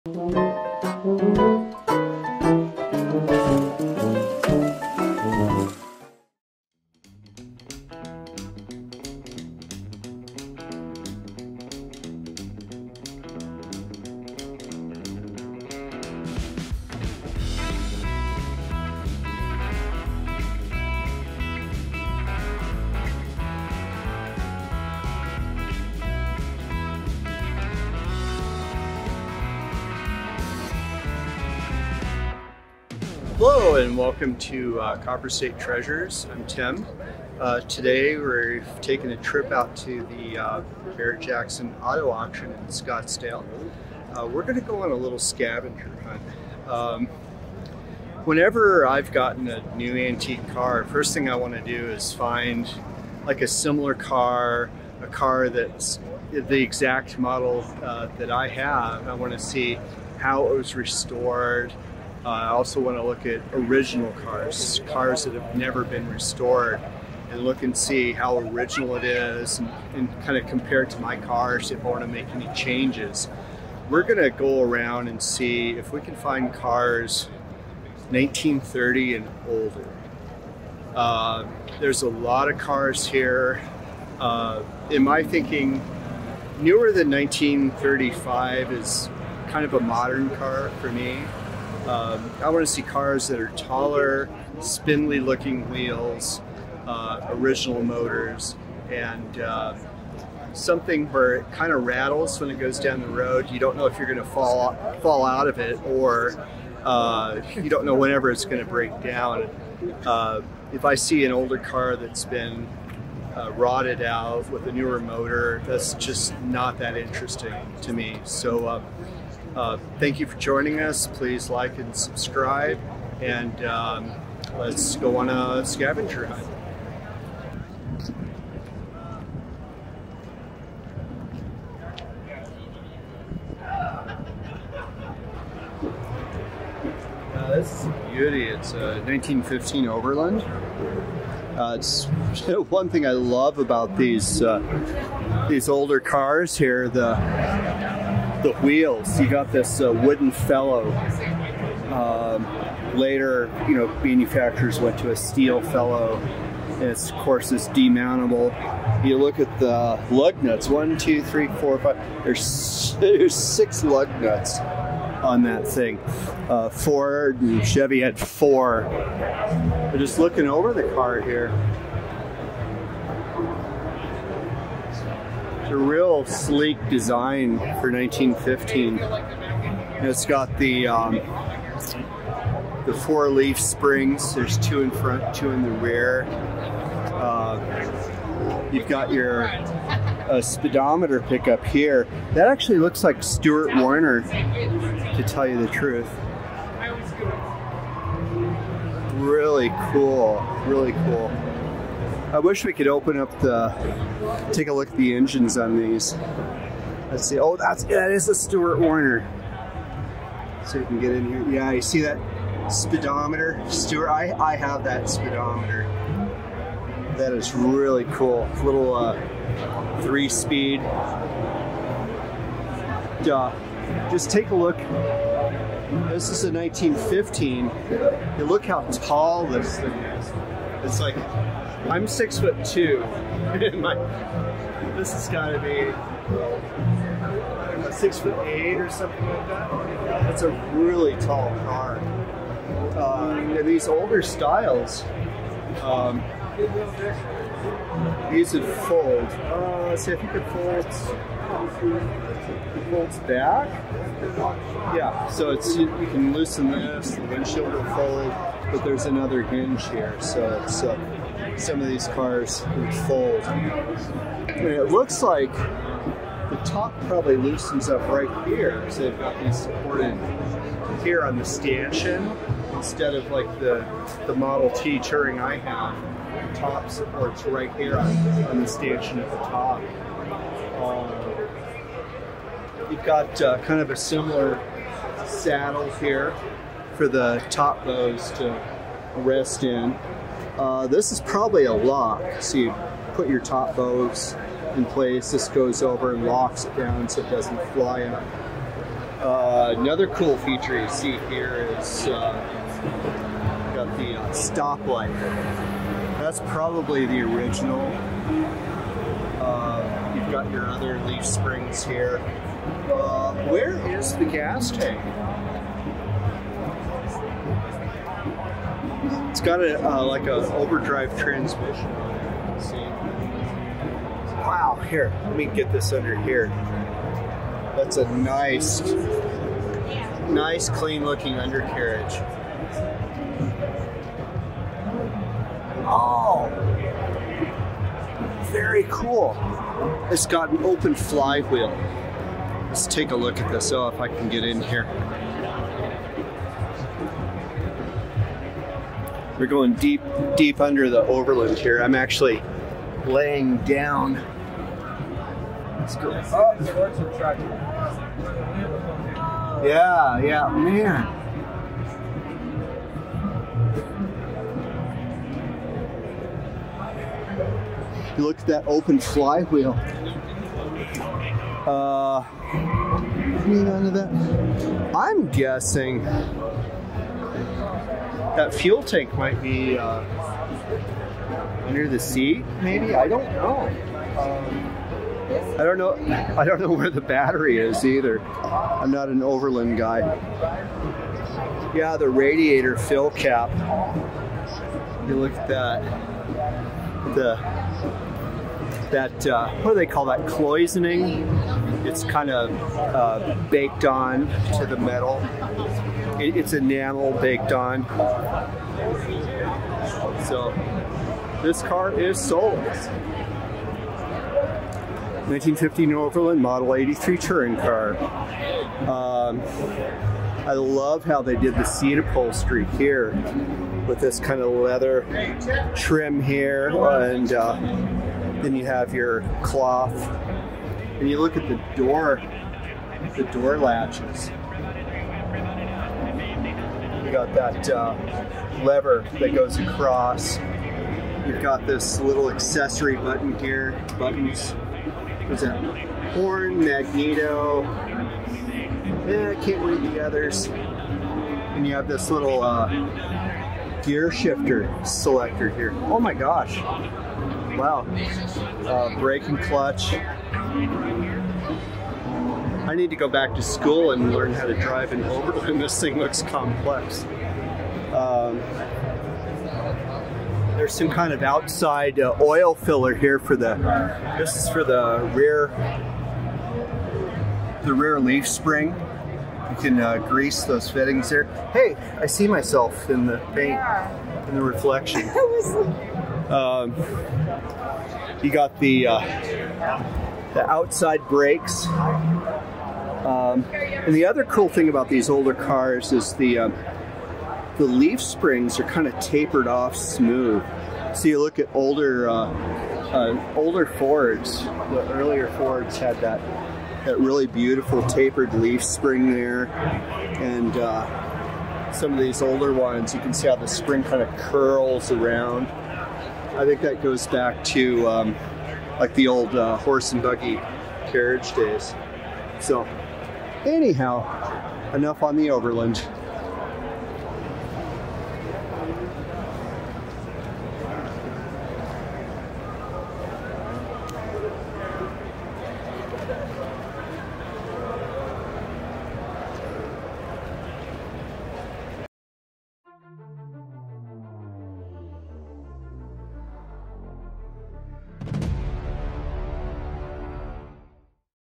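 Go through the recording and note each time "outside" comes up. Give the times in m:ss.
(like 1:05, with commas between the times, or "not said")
7:51, 8:10.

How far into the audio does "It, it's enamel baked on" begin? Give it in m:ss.
6:46.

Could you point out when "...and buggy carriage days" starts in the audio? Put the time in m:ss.
8:39.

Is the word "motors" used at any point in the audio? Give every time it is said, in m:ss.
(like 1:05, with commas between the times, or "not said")
1:37, 1:54.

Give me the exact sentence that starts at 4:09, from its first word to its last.
Uh, let's see if you could fold.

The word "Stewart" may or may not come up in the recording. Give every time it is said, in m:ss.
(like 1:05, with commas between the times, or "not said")
3:13, 3:28, 3:33.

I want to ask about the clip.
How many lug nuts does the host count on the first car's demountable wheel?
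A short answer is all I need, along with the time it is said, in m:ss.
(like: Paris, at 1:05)
6, at 2:43.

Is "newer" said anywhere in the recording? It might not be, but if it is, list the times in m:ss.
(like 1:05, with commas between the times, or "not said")
1:26, 1:54.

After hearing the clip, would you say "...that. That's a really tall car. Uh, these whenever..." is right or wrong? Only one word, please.
wrong.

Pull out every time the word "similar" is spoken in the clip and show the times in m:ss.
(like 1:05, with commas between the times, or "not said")
0:53, 4:43.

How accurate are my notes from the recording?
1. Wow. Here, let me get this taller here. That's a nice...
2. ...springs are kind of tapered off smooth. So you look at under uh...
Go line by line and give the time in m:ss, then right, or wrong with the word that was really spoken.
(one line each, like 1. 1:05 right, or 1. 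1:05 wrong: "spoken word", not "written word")
1. 5:24 wrong: "under", not "taller"
2. 8:18 wrong: "older", not "under".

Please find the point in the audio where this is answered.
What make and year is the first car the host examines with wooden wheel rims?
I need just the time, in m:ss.
2:19.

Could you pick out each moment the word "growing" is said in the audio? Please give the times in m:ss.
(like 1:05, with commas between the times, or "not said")
not said.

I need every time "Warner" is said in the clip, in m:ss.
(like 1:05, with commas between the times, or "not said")
3:13, 3:28.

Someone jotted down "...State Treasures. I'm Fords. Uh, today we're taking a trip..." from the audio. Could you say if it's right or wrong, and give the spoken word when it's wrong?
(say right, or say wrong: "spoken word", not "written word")
wrong: "Tim", not "Fords".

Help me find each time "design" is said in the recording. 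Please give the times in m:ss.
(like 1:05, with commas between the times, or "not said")
2:56.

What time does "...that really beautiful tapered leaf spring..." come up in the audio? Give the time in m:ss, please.
8:26.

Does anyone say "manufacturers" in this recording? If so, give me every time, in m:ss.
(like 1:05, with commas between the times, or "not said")
2:34.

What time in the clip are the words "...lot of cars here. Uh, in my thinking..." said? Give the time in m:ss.
1:22.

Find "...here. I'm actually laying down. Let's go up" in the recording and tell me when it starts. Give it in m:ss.
5:51.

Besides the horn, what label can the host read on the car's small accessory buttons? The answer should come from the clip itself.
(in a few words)
magneto.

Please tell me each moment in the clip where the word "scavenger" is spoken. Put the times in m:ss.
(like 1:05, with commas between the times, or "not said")
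0:45, 2:05.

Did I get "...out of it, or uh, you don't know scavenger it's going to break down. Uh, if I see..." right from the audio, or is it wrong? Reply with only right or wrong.
wrong.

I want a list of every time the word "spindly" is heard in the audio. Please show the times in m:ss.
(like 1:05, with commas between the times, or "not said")
1:34.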